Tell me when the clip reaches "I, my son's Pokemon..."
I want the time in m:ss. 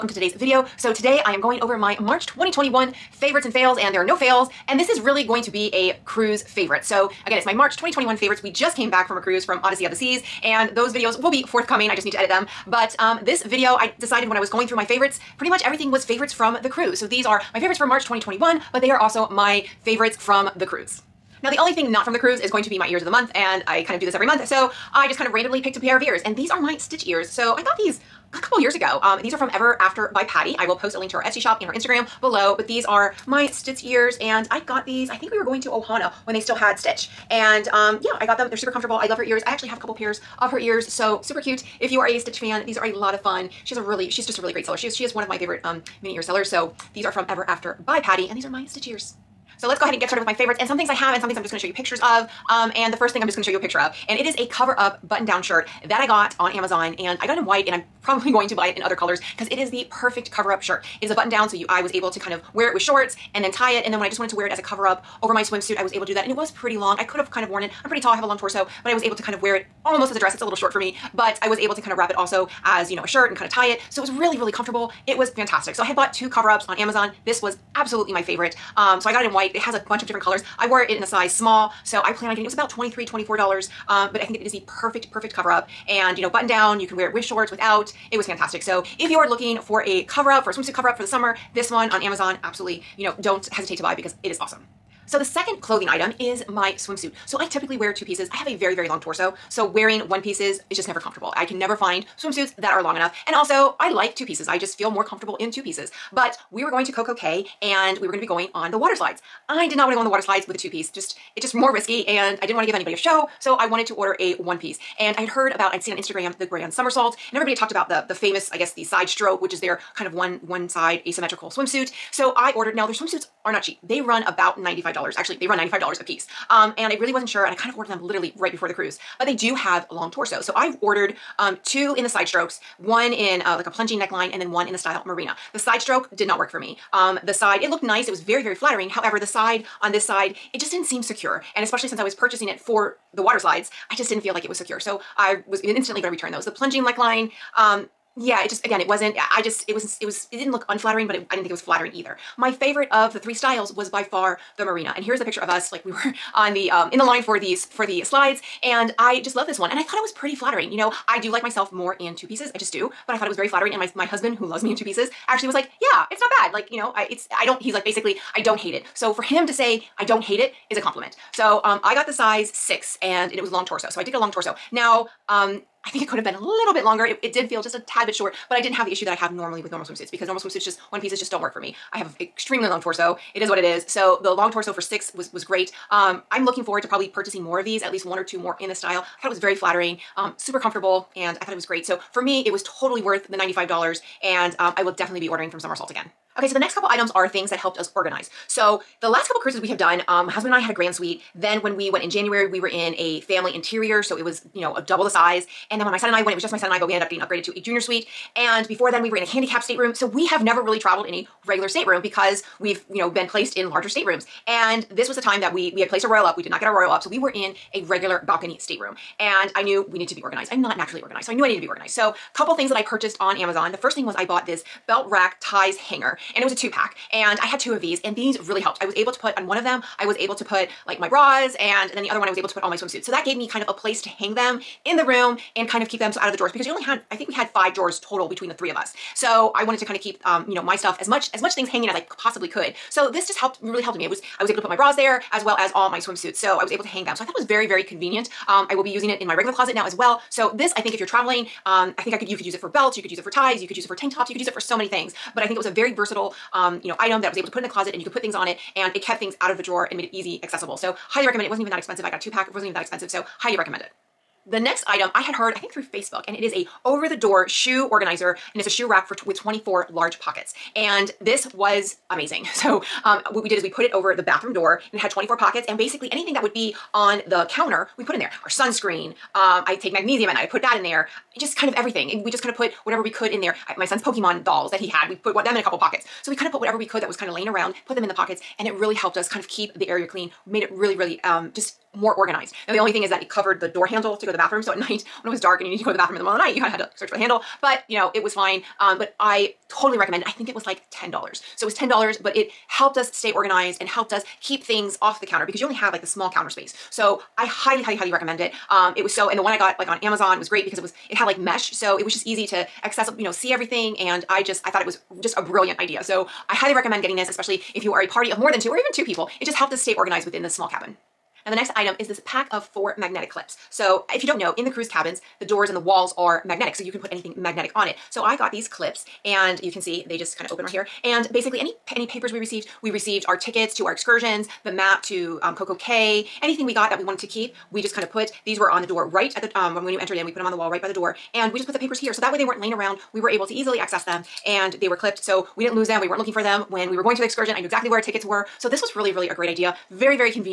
4:43.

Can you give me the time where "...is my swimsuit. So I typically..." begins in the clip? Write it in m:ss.
1:36.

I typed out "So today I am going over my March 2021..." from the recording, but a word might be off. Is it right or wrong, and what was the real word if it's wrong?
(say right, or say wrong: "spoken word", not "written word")
right.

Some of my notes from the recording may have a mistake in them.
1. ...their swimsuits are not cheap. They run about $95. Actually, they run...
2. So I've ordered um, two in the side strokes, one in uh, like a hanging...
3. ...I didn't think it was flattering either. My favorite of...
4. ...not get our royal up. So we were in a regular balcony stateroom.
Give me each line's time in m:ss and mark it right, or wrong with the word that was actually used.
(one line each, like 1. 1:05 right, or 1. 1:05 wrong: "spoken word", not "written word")
1. 2:02 right
2. 2:10 wrong: "plunging", not "hanging"
3. 2:31 right
4. 3:36 right.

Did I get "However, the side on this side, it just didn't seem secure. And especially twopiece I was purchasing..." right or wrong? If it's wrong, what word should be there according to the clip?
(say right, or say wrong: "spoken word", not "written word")
wrong: "since", not "twopiece".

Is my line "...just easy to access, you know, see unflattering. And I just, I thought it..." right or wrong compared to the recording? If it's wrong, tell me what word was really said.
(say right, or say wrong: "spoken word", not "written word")
wrong: "everything", not "unflattering".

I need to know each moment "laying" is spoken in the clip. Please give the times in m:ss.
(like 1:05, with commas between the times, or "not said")
4:47, 5:42.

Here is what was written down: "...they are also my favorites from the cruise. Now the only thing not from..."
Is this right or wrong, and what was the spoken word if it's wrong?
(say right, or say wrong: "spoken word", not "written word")
right.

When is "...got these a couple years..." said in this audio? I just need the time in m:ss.
0:27.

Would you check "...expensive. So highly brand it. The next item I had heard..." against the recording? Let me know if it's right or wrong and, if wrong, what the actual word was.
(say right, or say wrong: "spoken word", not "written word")
wrong: "recommend", not "brand".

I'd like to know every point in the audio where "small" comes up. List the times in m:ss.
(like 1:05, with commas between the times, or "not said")
1:21, 5:06, 5:20.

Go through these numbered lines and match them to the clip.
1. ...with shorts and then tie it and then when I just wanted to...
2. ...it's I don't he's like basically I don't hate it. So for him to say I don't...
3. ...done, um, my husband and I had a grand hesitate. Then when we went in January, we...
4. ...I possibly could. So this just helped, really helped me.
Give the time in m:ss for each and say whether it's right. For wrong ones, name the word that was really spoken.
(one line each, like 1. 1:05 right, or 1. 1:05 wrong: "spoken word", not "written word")
1. 1:02 right
2. 2:47 right
3. 3:19 wrong: "suite", not "hesitate"
4. 4:01 right.